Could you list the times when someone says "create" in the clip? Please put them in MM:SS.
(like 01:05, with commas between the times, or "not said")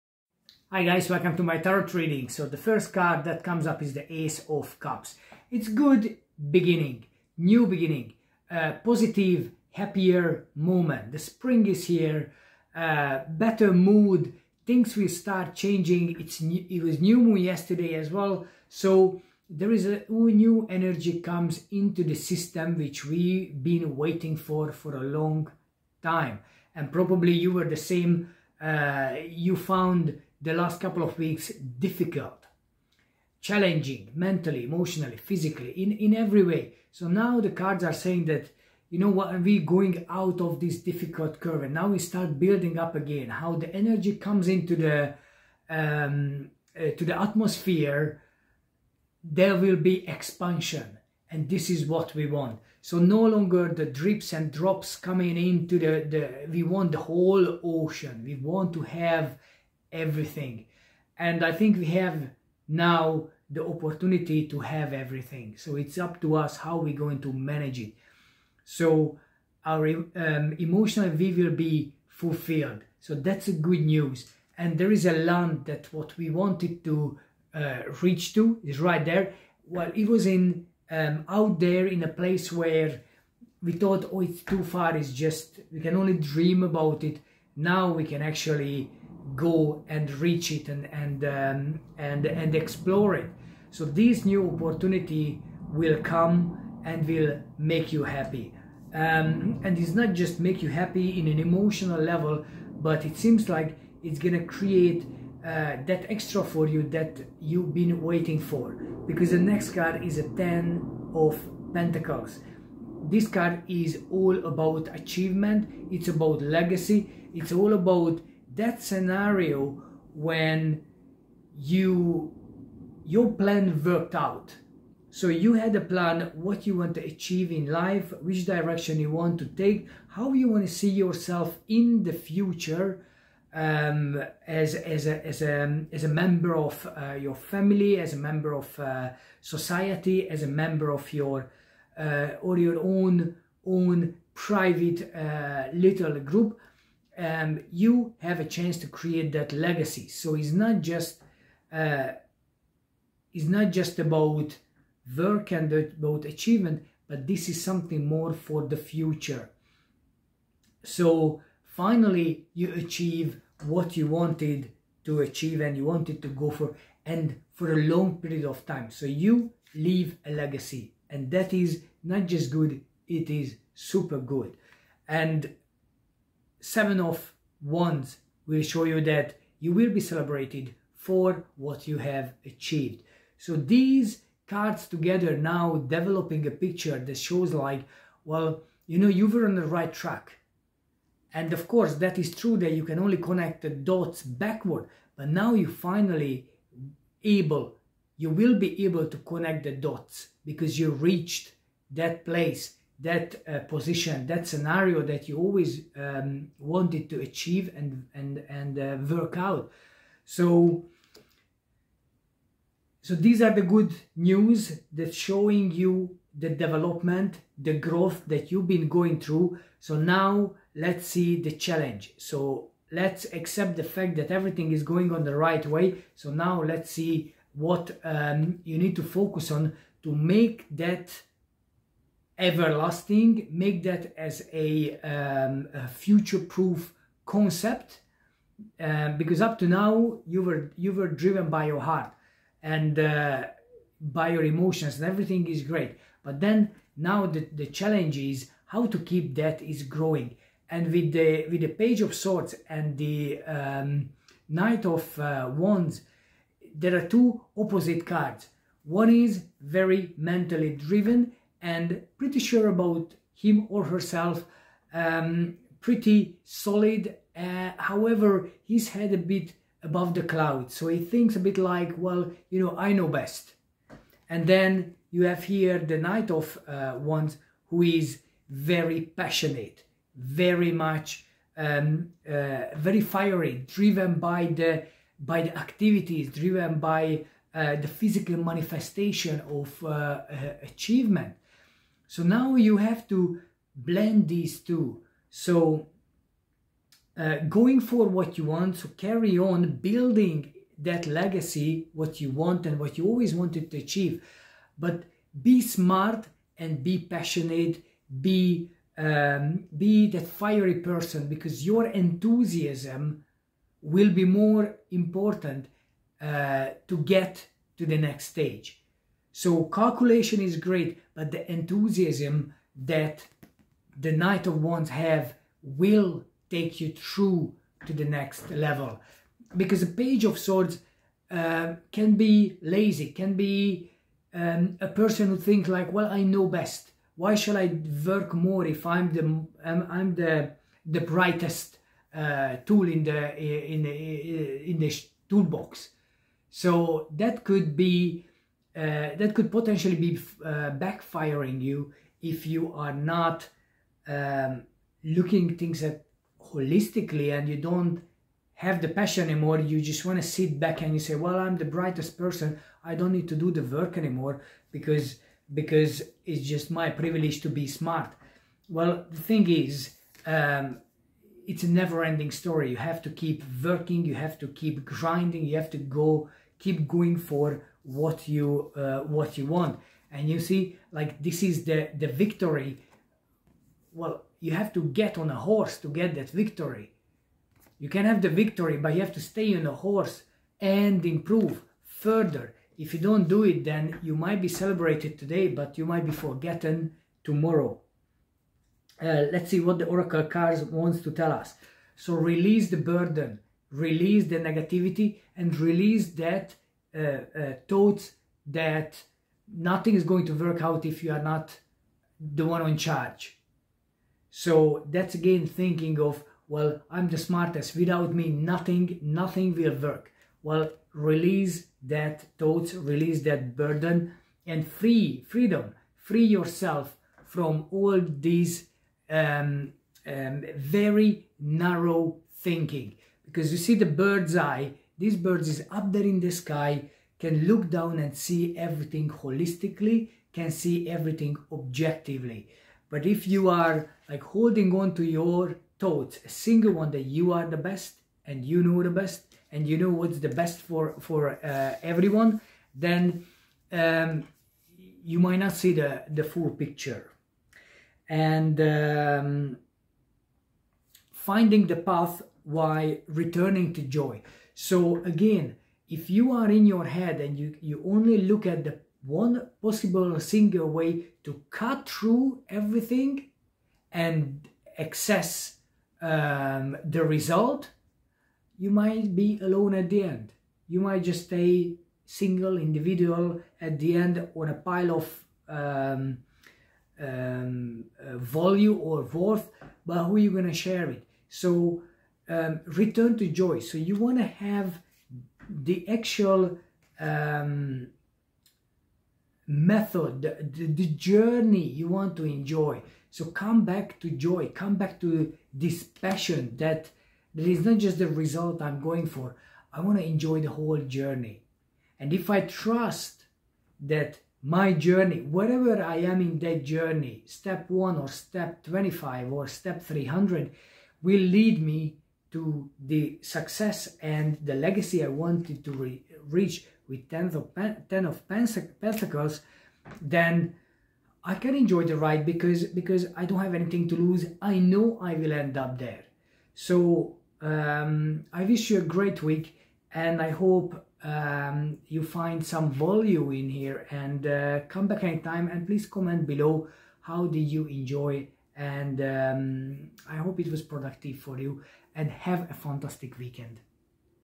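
01:44, 02:28.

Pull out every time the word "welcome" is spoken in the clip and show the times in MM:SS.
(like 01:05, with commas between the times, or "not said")
00:01.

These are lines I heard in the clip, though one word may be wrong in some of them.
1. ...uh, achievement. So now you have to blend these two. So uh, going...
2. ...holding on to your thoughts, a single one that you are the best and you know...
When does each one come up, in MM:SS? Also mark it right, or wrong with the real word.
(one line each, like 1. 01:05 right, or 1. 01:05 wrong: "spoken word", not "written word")
1. 04:49 right
2. 07:24 right.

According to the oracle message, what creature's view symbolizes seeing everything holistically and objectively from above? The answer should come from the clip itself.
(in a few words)
Bird.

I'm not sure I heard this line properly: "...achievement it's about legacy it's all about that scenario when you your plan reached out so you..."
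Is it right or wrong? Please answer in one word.
wrong.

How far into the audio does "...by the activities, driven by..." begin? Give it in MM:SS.
04:45.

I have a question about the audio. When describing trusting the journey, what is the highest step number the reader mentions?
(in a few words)
300.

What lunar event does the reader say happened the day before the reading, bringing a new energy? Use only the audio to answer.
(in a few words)
New moon.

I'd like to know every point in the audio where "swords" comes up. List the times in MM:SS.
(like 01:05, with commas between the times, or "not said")
04:12, 05:30.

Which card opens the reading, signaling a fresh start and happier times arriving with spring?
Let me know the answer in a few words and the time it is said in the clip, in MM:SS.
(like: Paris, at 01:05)
Ace of Cups, at 00:04.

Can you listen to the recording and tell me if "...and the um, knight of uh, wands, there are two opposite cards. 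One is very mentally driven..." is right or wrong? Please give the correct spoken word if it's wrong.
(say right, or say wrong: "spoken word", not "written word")
right.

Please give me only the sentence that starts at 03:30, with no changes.
So, so these are the good news that showing you the development, the growth that you've been going through.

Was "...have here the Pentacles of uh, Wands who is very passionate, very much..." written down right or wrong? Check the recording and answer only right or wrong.
wrong.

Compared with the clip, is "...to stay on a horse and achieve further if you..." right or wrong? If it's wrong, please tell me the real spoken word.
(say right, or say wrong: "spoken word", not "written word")
wrong: "improve", not "achieve".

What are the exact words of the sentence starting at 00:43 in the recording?
How the energy comes into the, um, uh, to the atmosphere, there will be expansion and this is what we want.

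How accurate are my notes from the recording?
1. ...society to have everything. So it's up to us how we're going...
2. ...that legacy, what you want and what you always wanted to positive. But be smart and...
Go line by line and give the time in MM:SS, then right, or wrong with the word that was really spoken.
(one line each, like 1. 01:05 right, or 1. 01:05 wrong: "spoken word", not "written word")
1. 01:03 wrong: "opportunity", not "society"
2. 05:00 wrong: "achieve", not "positive".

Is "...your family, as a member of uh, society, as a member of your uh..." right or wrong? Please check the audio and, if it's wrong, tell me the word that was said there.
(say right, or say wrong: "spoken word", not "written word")
right.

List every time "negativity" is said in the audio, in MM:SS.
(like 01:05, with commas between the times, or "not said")
06:44.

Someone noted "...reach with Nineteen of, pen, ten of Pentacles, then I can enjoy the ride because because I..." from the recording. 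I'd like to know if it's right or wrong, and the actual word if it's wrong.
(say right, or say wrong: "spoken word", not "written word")
wrong: "Ten", not "Nineteen".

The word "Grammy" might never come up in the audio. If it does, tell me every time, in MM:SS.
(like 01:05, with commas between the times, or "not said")
not said.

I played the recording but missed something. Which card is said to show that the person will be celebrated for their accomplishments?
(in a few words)
Seven of Wands.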